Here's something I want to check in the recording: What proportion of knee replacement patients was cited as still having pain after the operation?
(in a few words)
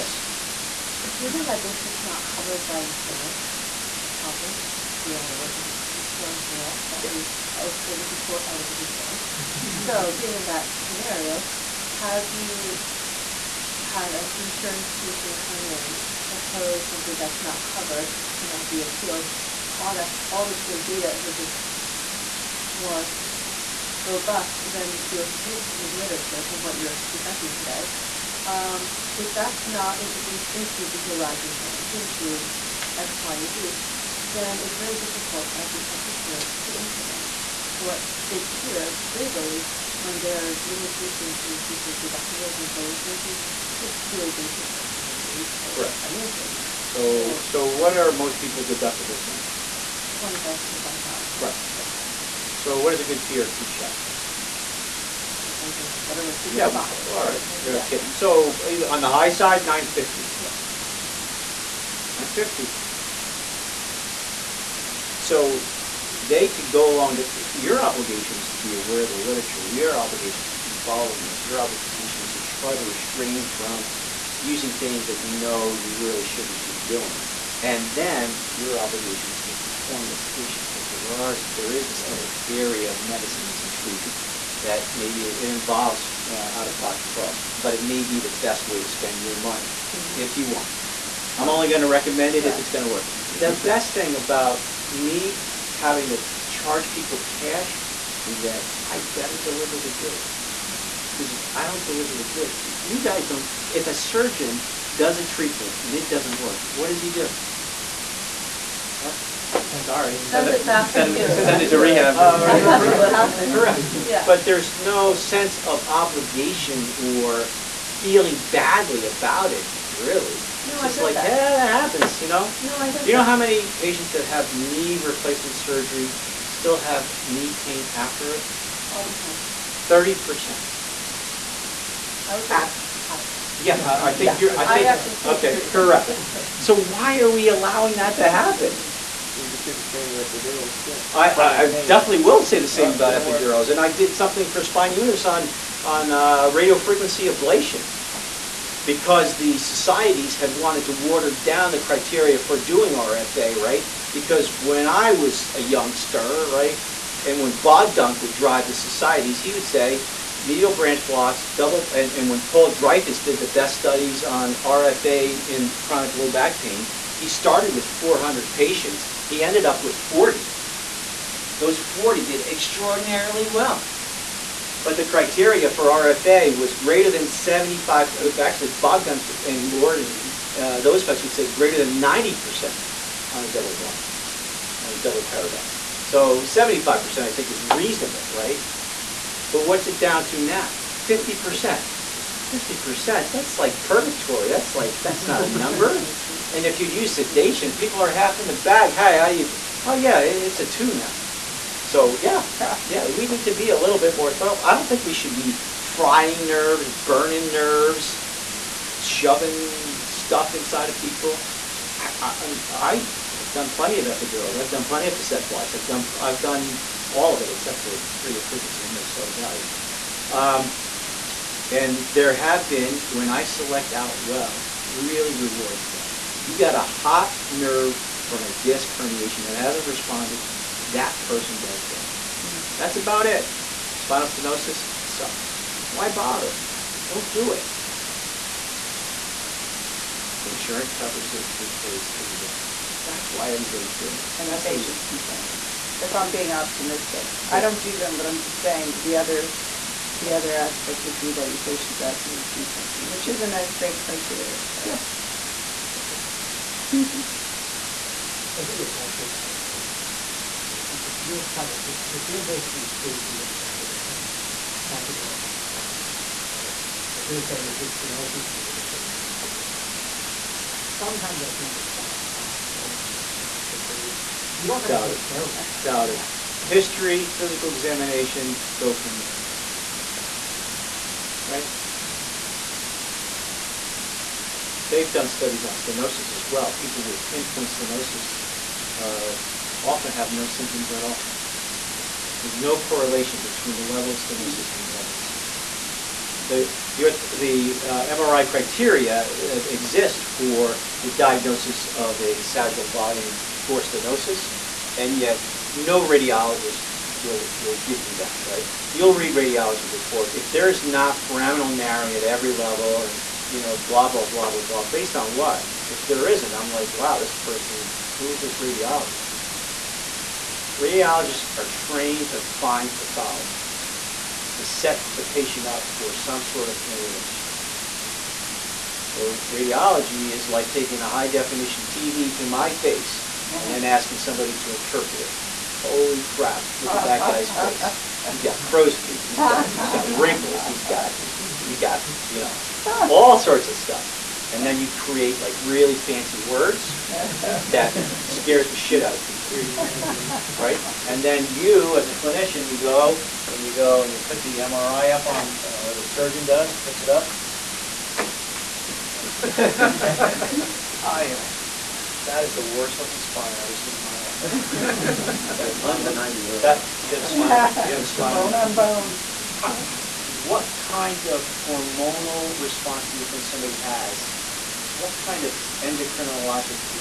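30%.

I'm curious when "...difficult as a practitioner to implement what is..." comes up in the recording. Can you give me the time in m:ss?
0:34.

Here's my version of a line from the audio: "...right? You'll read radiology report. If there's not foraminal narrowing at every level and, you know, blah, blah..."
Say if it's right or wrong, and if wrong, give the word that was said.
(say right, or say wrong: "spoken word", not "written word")
right.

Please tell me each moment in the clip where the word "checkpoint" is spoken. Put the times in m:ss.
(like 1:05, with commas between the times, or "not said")
not said.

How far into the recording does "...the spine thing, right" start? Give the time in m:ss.
4:25.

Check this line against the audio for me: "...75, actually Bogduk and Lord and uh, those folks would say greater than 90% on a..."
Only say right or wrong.
right.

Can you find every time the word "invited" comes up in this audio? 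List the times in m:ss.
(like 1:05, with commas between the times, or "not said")
not said.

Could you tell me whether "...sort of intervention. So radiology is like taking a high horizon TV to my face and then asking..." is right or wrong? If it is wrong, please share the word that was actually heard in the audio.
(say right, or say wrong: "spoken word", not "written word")
wrong: "definition", not "horizon".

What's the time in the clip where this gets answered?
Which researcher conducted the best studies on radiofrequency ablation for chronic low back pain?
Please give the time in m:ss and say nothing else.
2:42.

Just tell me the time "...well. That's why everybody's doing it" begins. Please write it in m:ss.
4:02.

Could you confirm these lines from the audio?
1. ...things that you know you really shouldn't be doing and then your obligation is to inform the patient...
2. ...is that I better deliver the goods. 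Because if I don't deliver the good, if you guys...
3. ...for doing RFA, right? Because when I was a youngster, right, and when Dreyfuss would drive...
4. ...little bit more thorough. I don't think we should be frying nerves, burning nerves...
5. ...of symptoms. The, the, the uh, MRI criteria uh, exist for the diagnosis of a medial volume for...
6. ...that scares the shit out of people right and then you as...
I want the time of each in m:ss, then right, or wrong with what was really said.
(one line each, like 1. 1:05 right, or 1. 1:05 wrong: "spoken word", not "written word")
1. 1:14 right
2. 1:38 right
3. 2:32 wrong: "Bogduk", not "Dreyfuss"
4. 3:23 right
5. 4:55 wrong: "sagittal", not "medial"
6. 5:47 right.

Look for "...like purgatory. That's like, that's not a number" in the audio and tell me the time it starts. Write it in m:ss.
3:13.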